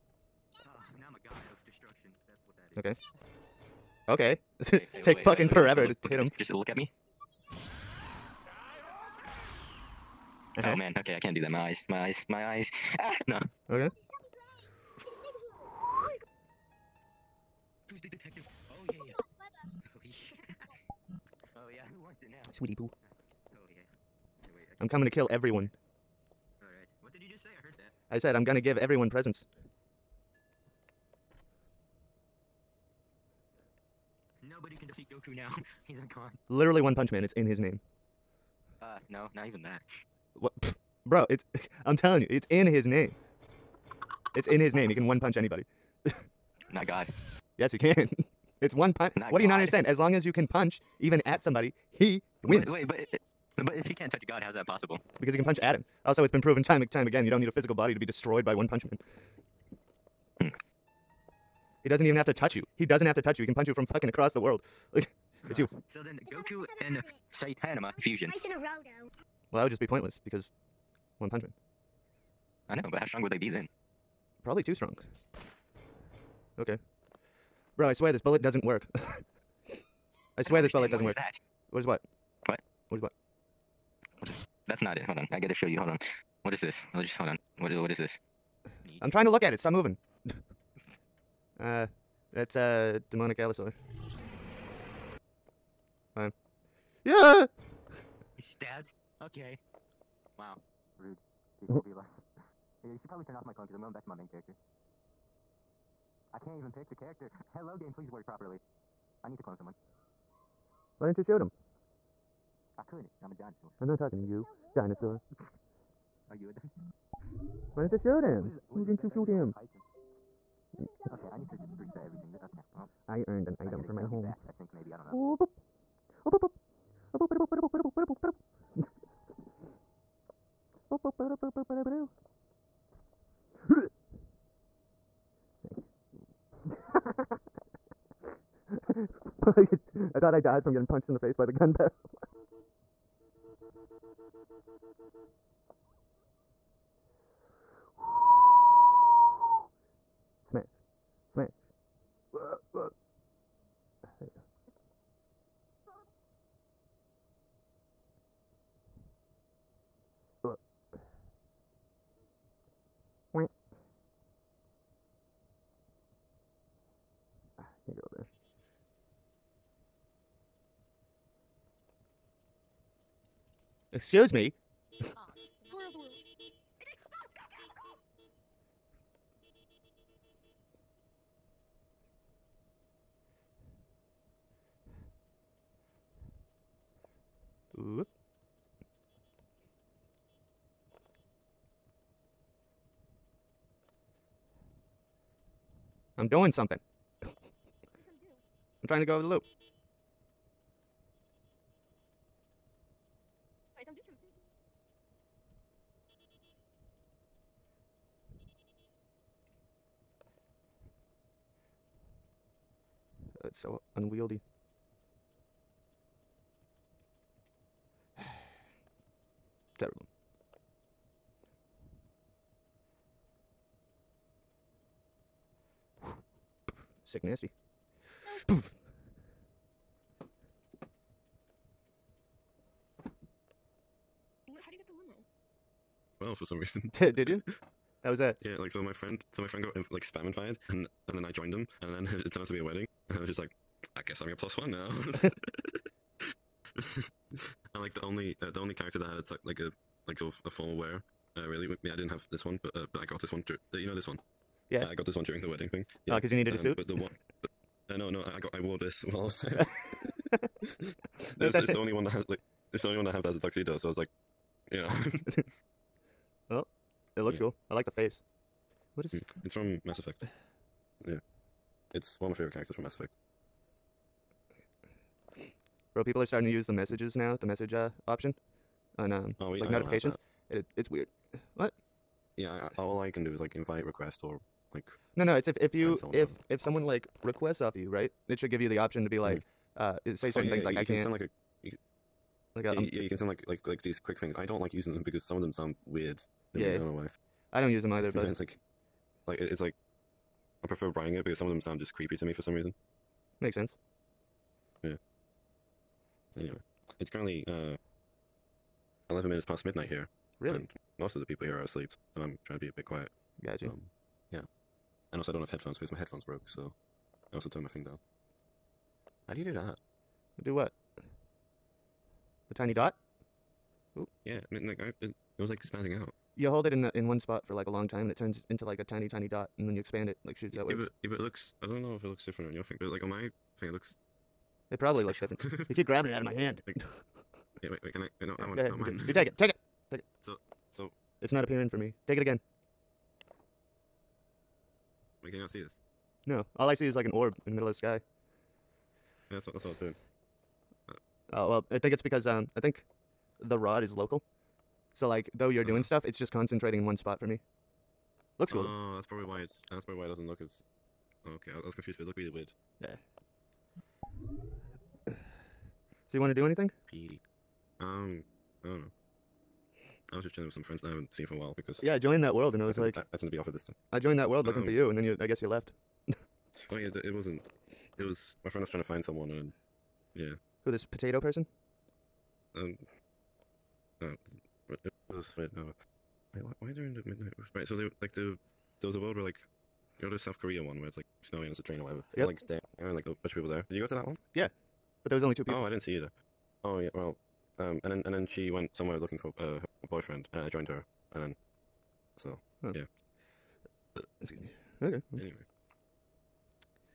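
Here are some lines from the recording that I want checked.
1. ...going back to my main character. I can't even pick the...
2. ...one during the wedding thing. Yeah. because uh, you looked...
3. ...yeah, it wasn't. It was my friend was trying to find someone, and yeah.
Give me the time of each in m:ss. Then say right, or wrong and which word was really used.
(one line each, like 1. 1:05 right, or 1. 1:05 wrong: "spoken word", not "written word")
1. 1:43 right
2. 4:15 wrong: "needed", not "looked"
3. 6:16 right.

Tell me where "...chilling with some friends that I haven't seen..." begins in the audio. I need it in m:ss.
6:10.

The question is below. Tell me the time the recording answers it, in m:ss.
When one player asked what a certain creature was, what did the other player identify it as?
1:33.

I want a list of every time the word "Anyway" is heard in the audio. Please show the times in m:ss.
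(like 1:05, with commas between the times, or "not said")
5:06, 6:45.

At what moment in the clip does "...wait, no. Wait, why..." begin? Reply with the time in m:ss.
6:25.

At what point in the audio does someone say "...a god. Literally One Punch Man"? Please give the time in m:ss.
0:35.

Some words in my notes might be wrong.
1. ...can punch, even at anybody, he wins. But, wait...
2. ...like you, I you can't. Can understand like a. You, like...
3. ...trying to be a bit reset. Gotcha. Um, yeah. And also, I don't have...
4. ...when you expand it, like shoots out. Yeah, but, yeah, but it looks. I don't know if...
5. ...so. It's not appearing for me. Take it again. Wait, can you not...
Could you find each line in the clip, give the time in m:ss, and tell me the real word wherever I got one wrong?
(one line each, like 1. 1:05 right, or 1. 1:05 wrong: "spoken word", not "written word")
1. 0:50 wrong: "somebody", not "anybody"
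2. 4:50 wrong: "sound", not "understand"
3. 5:12 wrong: "quiet", not "reset"
4. 5:29 right
5. 5:40 right.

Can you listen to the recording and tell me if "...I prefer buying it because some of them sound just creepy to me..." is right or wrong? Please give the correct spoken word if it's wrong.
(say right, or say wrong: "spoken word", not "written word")
right.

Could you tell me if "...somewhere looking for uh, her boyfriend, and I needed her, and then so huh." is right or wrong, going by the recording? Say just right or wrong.
wrong.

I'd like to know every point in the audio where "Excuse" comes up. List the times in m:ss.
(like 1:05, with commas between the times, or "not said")
2:53, 6:44.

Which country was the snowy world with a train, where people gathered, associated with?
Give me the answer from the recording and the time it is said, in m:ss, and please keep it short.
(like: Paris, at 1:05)
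South Korea, at 6:30.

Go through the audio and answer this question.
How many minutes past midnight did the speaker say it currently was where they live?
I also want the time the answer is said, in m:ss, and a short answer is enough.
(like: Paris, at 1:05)
11, at 5:09.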